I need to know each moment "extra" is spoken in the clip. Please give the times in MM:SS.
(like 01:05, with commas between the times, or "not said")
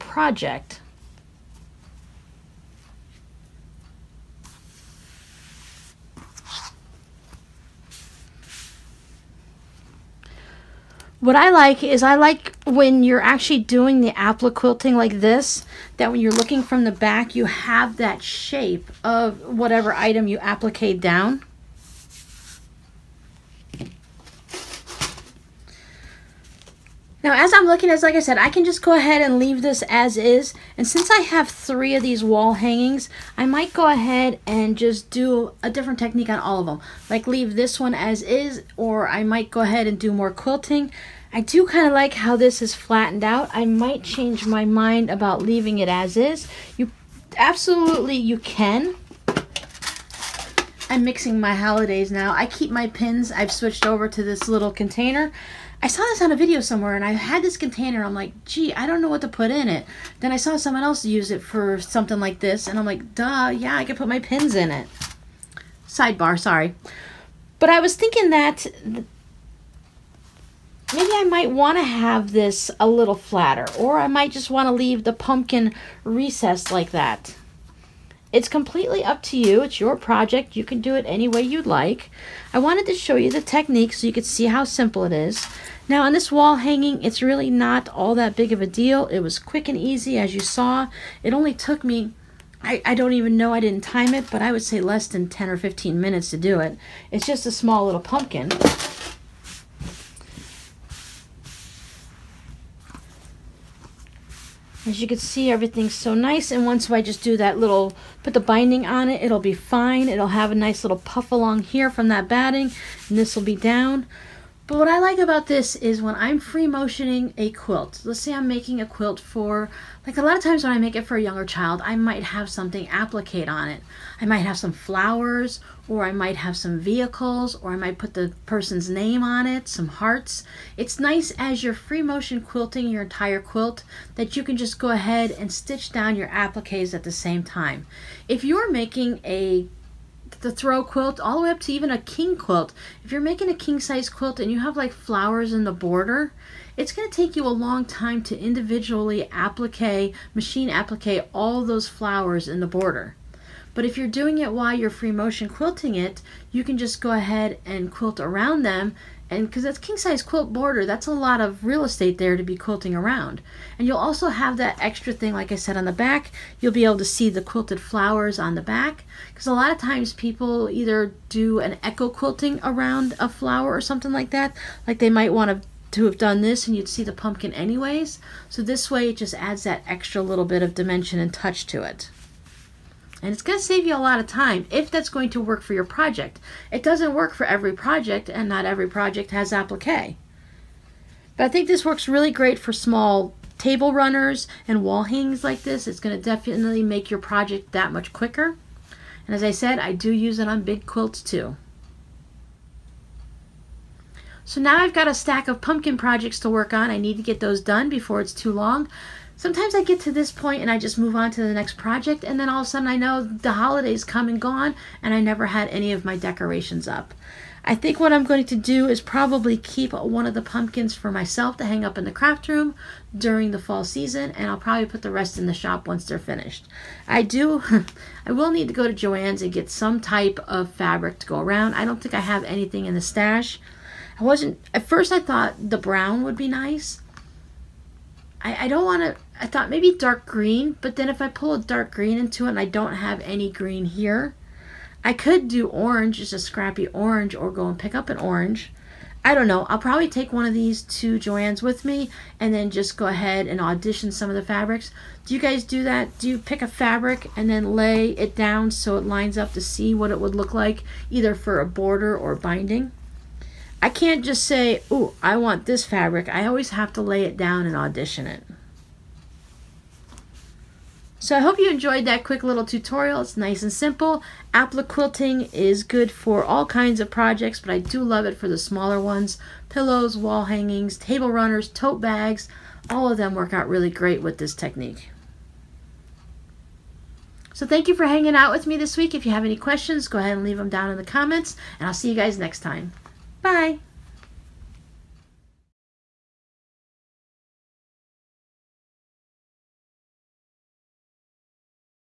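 02:44, 02:59.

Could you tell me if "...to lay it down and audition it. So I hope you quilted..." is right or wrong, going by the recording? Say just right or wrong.
wrong.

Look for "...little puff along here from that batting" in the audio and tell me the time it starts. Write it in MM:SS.
01:50.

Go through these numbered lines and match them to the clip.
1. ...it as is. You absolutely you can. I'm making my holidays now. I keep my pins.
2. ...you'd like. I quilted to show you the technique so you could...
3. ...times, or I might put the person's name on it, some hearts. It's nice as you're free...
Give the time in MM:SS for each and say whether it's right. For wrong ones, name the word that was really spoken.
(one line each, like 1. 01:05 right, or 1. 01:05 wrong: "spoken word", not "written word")
1. 00:45 wrong: "mixing", not "making"
2. 01:21 wrong: "wanted", not "quilted"
3. 02:06 wrong: "vehicles", not "times".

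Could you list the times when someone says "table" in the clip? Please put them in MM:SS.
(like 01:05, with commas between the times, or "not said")
03:13, 04:40.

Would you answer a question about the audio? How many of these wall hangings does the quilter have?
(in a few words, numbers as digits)
3.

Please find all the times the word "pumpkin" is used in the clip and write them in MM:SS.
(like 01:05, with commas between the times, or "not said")
01:15, 01:38, 02:57, 03:25, 03:40.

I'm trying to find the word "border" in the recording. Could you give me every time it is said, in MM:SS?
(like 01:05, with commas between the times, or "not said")
02:25, 02:32, 02:40, 04:21.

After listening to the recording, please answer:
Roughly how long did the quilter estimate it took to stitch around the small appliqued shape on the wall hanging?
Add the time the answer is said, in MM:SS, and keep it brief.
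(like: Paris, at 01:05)
10 or 15 minutes, at 01:35.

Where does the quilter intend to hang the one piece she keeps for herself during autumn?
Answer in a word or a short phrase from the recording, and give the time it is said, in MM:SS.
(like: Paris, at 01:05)
craft room, at 03:42.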